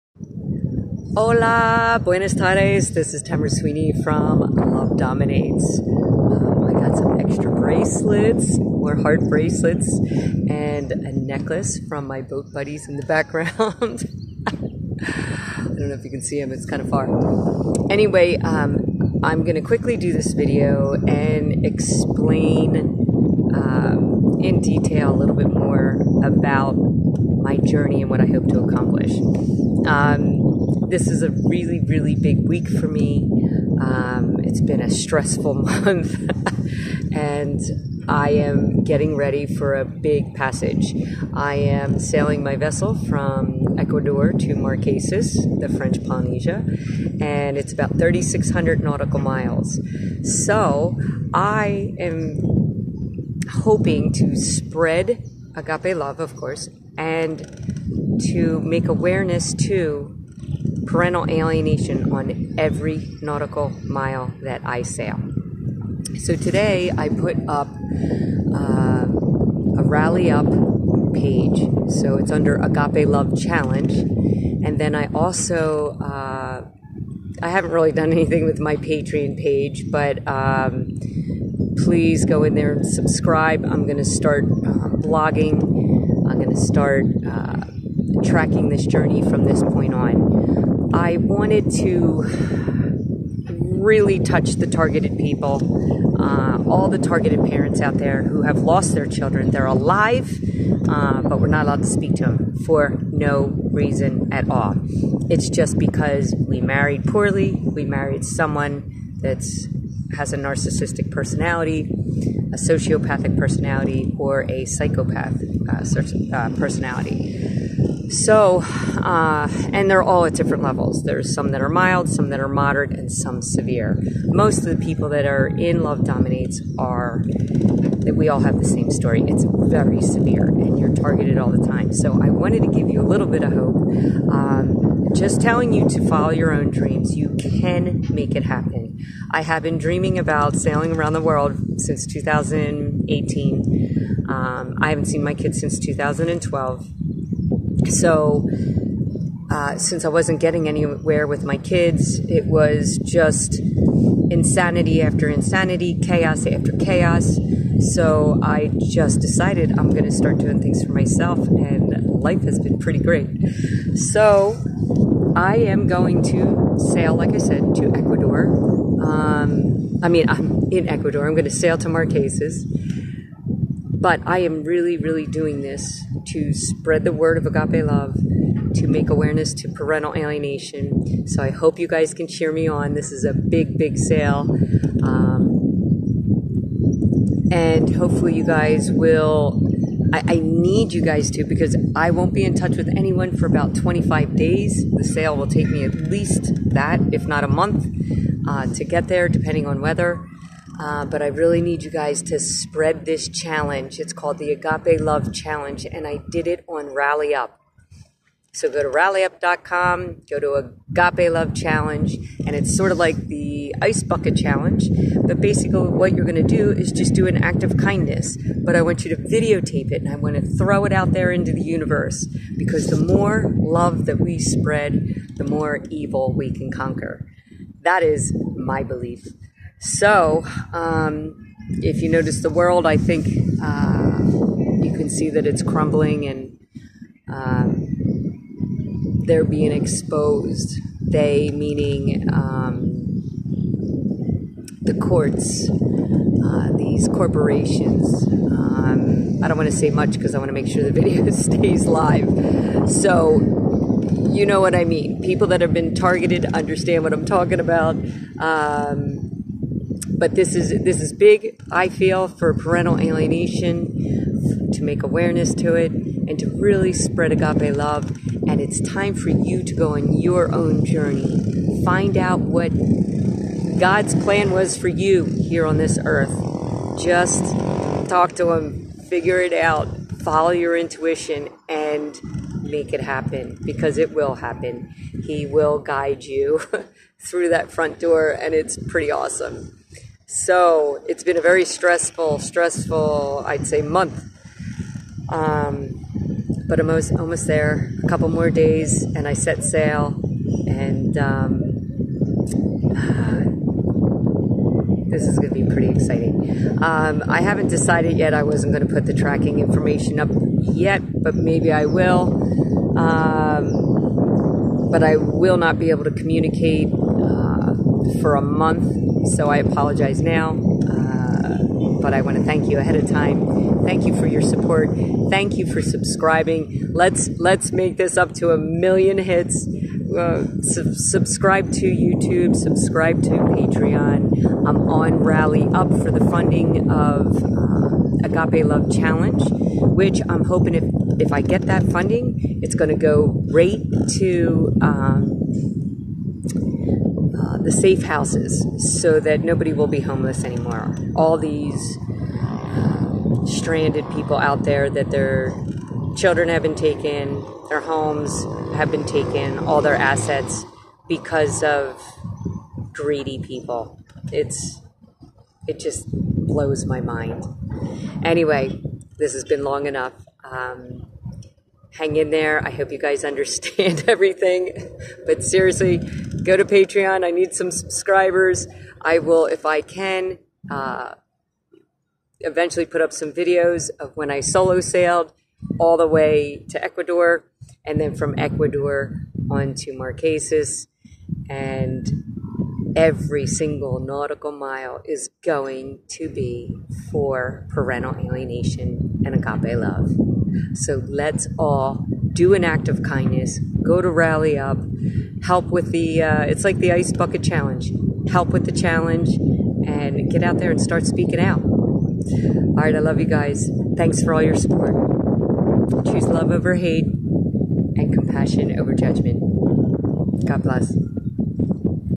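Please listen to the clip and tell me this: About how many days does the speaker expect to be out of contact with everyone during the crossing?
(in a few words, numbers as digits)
25.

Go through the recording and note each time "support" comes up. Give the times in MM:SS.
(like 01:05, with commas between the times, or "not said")
05:24, 06:54.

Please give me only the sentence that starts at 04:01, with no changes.
They, meaning um, the courts, uh, these corporations.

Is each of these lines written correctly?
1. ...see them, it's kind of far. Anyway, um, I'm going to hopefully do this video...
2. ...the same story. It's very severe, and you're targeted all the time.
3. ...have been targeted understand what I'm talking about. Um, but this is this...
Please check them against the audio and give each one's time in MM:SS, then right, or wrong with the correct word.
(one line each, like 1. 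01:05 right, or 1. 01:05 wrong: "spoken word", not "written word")
1. 00:16 wrong: "quickly", not "hopefully"
2. 02:08 right
3. 04:15 right.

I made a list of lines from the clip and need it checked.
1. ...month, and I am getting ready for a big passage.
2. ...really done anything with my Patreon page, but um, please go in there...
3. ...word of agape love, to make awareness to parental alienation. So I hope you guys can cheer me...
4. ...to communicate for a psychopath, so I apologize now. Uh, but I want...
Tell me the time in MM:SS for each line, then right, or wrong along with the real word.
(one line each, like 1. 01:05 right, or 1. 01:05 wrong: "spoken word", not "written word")
1. 00:35 right
2. 01:17 right
3. 02:57 right
4. 05:16 wrong: "month", not "psychopath".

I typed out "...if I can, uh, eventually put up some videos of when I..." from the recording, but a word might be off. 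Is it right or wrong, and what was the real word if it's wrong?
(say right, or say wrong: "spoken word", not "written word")
right.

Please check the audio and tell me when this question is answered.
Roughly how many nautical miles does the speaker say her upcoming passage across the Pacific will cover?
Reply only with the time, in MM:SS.
00:47.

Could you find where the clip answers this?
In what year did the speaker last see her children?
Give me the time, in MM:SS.
02:25.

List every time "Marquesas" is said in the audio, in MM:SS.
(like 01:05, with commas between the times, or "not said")
00:44, 02:51, 06:29.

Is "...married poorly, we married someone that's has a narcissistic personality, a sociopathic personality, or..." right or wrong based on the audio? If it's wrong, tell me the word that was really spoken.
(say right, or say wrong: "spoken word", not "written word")
right.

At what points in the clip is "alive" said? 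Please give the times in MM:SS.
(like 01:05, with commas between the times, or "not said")
01:39.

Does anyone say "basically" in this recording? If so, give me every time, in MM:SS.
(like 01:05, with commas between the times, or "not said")
03:35.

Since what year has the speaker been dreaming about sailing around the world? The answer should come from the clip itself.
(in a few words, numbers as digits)
2018.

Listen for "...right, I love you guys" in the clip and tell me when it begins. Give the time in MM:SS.
06:52.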